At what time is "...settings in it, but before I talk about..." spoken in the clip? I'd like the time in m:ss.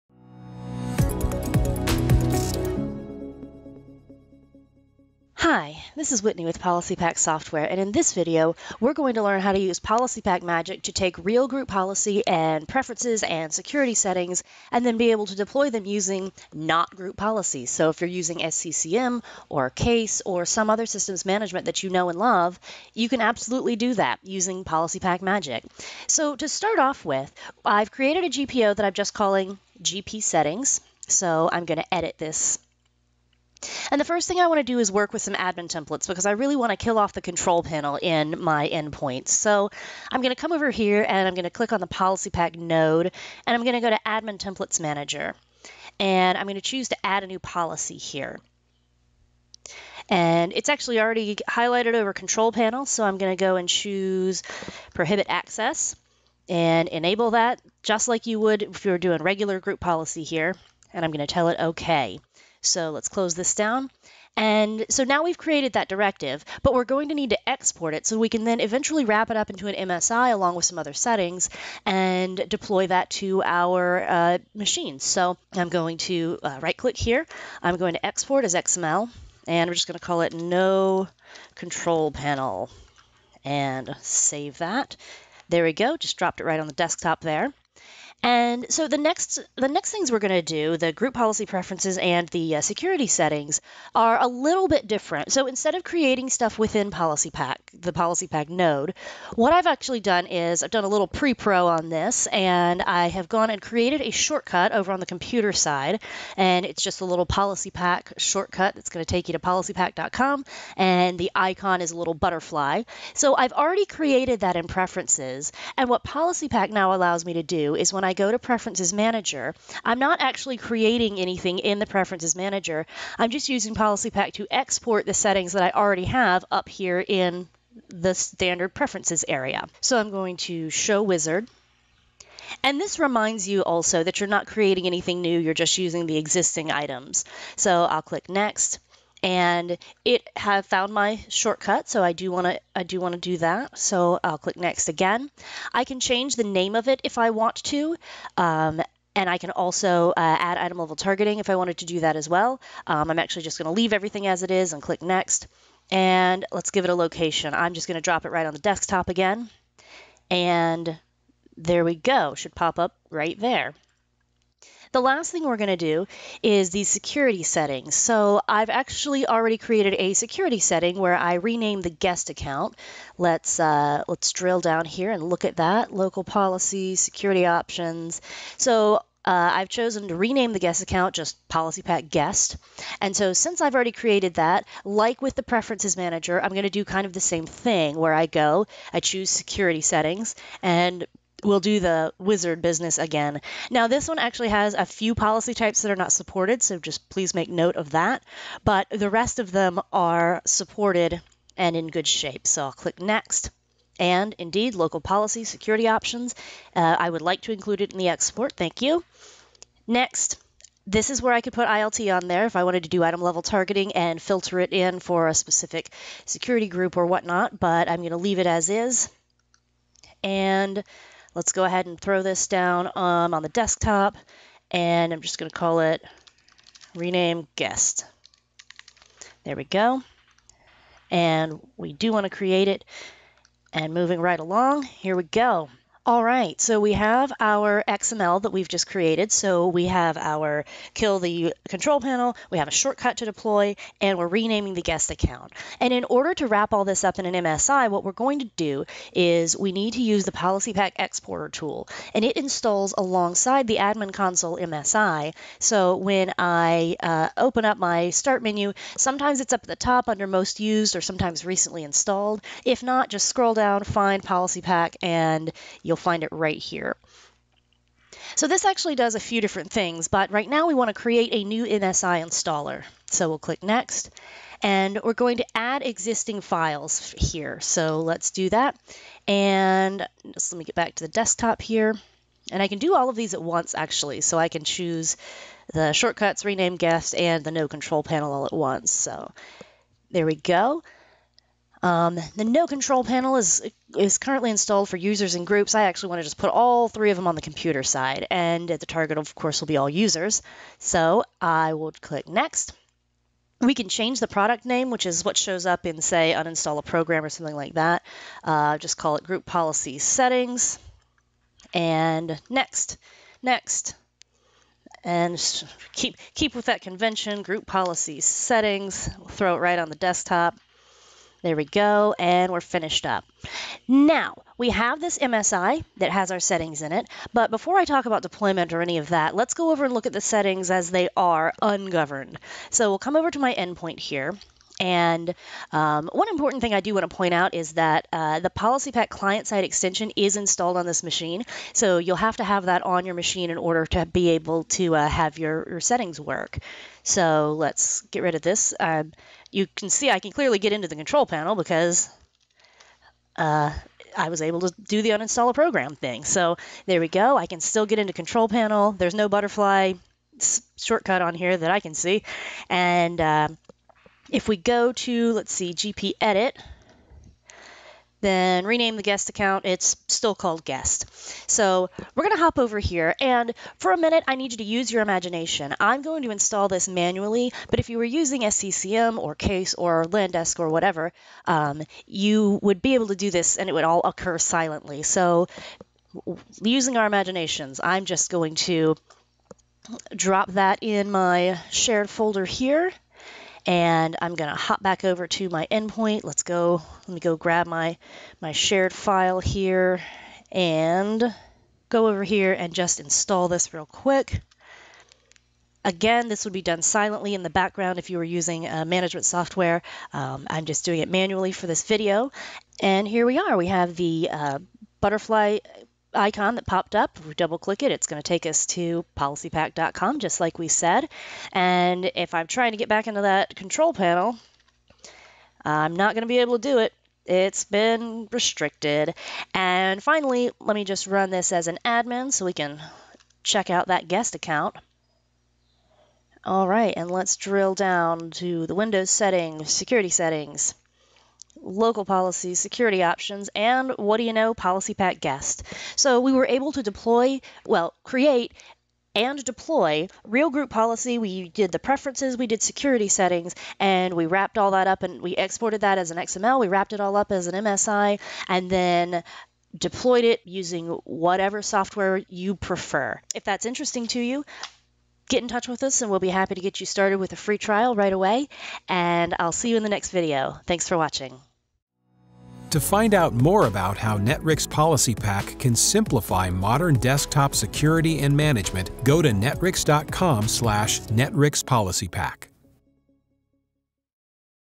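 5:26.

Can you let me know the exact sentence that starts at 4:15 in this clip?
So when I uh, open up my Start menu, sometimes it's up at the top under Most Used or sometimes Recently Installed.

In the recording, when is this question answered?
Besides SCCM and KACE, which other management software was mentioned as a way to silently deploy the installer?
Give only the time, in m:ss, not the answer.
6:20.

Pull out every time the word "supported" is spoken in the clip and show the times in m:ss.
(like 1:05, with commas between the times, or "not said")
3:16, 3:20.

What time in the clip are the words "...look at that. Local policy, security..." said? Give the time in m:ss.
2:55.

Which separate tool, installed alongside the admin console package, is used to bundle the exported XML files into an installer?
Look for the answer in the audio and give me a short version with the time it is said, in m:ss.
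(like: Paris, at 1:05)
PolicyPak Exporter, at 4:10.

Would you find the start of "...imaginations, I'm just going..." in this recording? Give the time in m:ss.
6:27.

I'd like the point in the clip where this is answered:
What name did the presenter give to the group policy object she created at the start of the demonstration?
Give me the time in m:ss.
0:29.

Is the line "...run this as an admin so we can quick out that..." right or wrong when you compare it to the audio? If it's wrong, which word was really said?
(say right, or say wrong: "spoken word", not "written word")
wrong: "check", not "quick".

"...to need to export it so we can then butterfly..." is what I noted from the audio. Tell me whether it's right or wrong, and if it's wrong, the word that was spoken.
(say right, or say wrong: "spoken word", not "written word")
wrong: "eventually", not "butterfly".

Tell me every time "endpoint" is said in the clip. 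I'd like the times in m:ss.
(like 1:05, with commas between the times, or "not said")
0:38, 5:33, 6:35.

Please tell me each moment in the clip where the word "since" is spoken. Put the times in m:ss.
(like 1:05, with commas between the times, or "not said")
3:03.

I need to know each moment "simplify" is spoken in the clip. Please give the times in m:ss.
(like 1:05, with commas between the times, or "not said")
7:55.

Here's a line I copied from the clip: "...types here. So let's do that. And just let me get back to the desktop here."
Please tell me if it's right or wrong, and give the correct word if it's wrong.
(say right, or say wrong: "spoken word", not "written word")
wrong: "files", not "types".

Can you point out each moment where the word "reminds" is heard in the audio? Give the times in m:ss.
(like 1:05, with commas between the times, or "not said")
2:12.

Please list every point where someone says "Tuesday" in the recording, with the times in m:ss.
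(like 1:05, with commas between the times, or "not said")
not said.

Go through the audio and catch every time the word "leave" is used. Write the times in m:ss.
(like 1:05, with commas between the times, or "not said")
2:33, 3:38.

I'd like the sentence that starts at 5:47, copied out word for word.
So let's get rid of this.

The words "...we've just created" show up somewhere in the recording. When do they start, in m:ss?
3:58.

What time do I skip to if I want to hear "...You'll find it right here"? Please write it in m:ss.
4:25.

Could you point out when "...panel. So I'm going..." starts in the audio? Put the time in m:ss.
0:52.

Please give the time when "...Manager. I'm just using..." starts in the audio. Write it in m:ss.
2:02.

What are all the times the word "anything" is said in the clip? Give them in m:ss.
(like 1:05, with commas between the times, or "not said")
2:01, 2:14.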